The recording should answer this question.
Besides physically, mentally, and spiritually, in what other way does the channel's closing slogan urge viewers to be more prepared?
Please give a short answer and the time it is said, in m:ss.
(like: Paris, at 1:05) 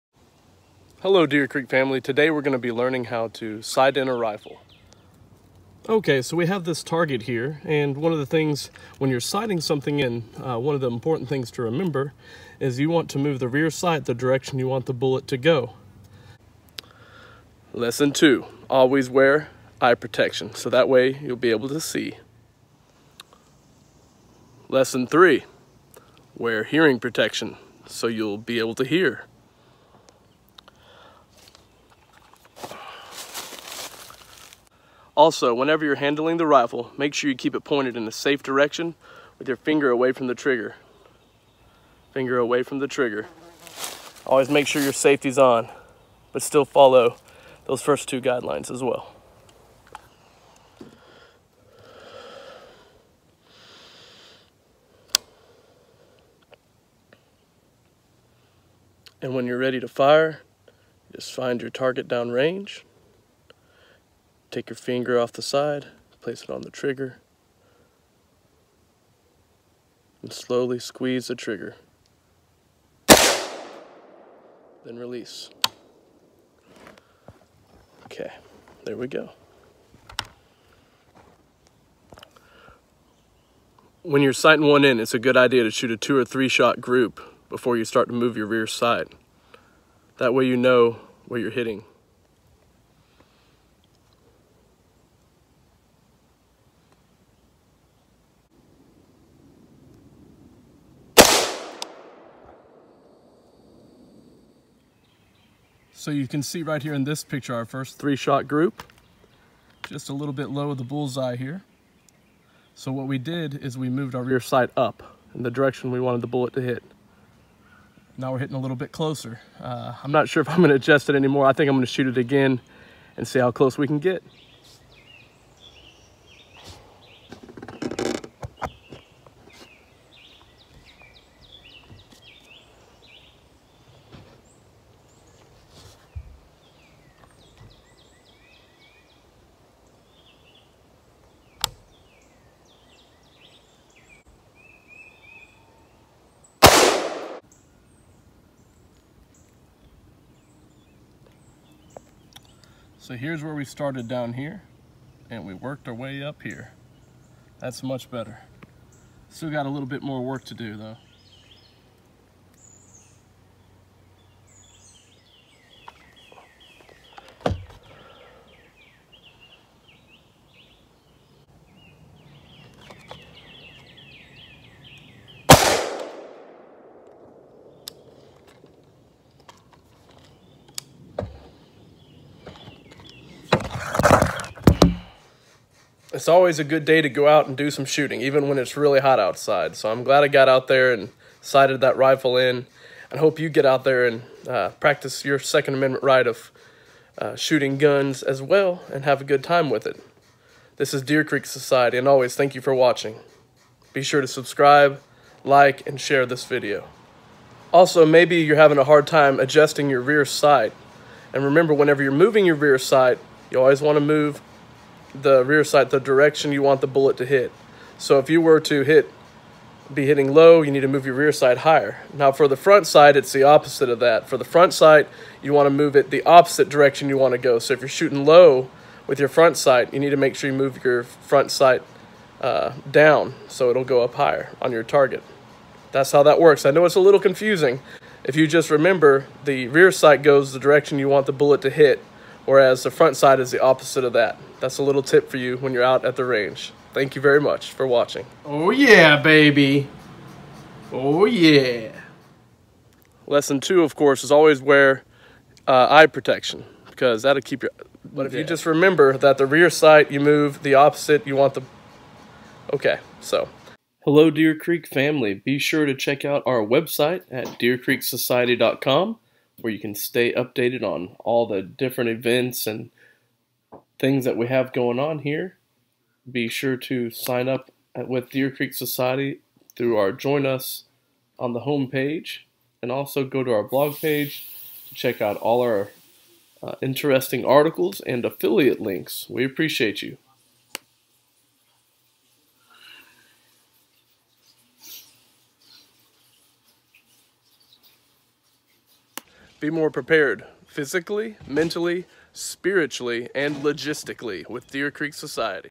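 Logistically, at 5:03.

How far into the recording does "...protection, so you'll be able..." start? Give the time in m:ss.
0:26.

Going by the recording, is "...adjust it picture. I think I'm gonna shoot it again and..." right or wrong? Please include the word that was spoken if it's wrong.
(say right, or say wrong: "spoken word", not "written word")
wrong: "anymore", not "picture".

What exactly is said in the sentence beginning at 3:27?
Also, maybe you're having a hard time adjusting your rear sight.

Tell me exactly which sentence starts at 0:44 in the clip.
Always make sure your safety's on, but still follow those first two guidelines as well.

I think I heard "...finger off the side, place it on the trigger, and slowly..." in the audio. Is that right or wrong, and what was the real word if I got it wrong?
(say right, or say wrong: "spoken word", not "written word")
right.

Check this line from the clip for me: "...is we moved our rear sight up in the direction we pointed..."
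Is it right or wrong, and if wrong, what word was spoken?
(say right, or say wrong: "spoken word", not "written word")
wrong: "wanted", not "pointed".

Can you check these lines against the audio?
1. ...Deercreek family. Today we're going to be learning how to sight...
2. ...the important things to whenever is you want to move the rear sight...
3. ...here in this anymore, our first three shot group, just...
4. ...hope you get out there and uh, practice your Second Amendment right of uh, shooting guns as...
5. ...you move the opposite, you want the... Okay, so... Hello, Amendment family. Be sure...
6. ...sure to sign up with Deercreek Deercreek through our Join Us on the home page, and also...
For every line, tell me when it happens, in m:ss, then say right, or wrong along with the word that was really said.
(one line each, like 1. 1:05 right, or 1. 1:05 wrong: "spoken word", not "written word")
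1. 0:01 right
2. 0:10 wrong: "remember", not "whenever"
3. 1:46 wrong: "picture", not "anymore"
4. 3:13 right
5. 4:20 wrong: "Deercreek", not "Amendment"
6. 4:36 wrong: "Society", not "Deercreek".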